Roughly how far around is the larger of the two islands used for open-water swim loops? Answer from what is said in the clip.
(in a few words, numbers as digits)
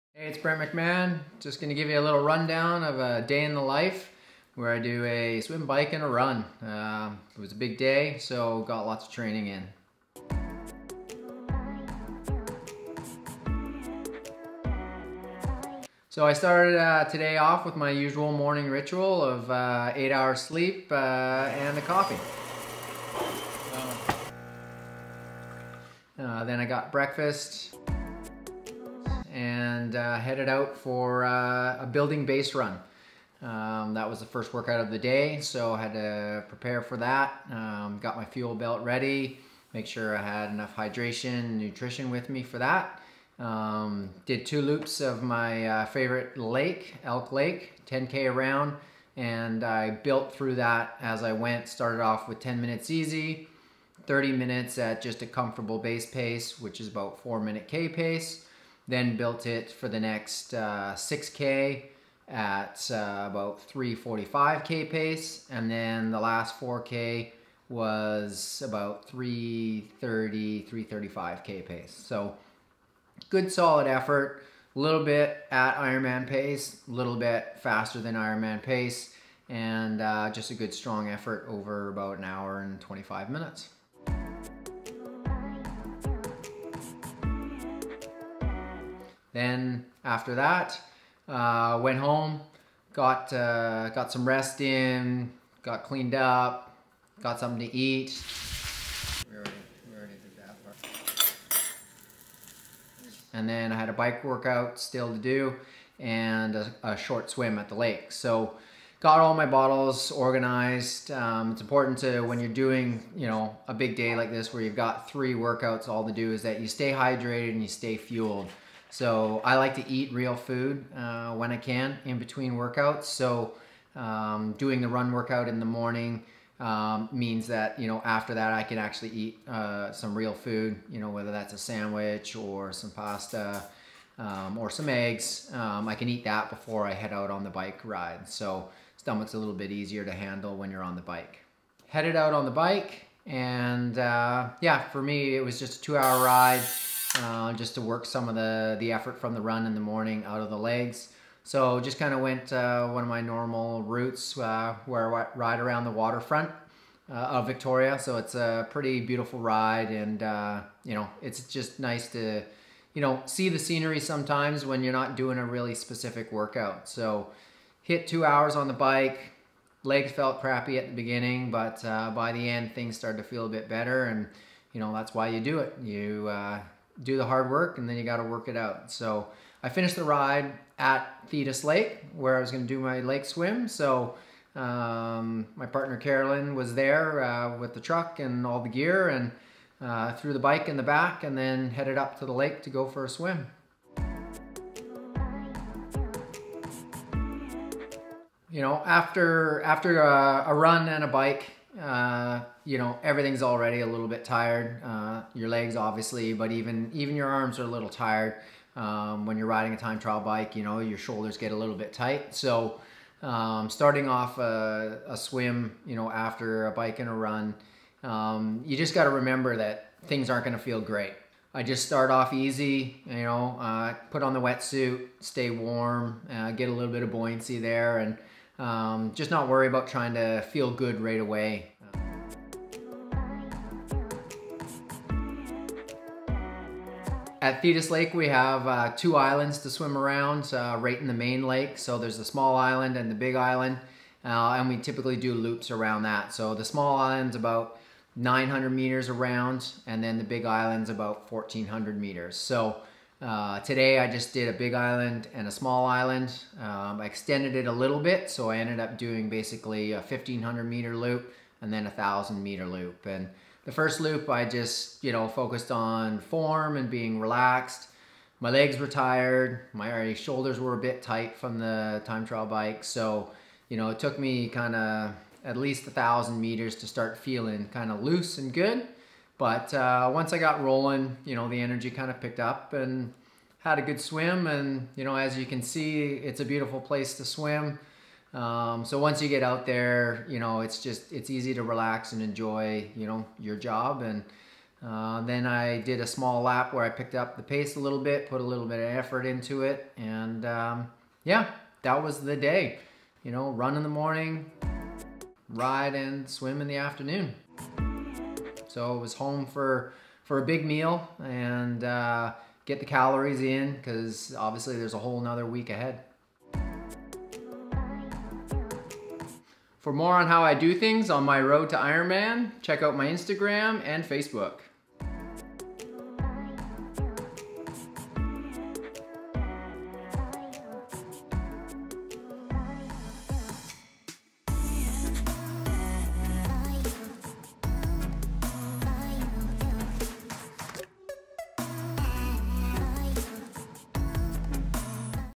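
1400 meters.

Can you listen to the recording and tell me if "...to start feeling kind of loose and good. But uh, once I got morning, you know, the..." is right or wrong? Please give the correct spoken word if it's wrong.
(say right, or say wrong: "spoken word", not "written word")
wrong: "rolling", not "morning".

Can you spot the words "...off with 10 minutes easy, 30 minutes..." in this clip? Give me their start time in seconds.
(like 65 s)
52 s.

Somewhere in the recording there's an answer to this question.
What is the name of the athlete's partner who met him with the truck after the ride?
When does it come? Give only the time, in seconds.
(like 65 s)
185 s.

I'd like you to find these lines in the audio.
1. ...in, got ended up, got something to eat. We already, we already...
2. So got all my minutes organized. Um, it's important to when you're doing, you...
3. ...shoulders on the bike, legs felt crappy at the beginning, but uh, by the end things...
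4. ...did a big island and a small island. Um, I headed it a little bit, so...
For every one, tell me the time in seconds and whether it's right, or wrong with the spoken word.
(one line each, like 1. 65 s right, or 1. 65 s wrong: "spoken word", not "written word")
1. 94 s wrong: "cleaned", not "ended"
2. 108 s wrong: "bottles", not "minutes"
3. 168 s wrong: "hours", not "shoulders"
4. 254 s wrong: "extended", not "headed".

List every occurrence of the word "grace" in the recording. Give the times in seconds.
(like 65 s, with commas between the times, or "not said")
not said.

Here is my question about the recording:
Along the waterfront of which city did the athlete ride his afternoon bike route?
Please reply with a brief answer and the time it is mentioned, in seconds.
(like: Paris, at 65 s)
Victoria, at 157 s.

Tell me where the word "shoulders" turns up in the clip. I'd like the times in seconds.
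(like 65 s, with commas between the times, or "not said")
210 s, 270 s.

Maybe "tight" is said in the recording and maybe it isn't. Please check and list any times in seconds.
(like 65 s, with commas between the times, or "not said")
211 s, 271 s.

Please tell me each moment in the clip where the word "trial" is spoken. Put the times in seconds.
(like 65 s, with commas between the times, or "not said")
209 s, 272 s.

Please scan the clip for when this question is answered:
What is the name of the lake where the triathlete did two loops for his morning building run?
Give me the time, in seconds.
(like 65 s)
47 s.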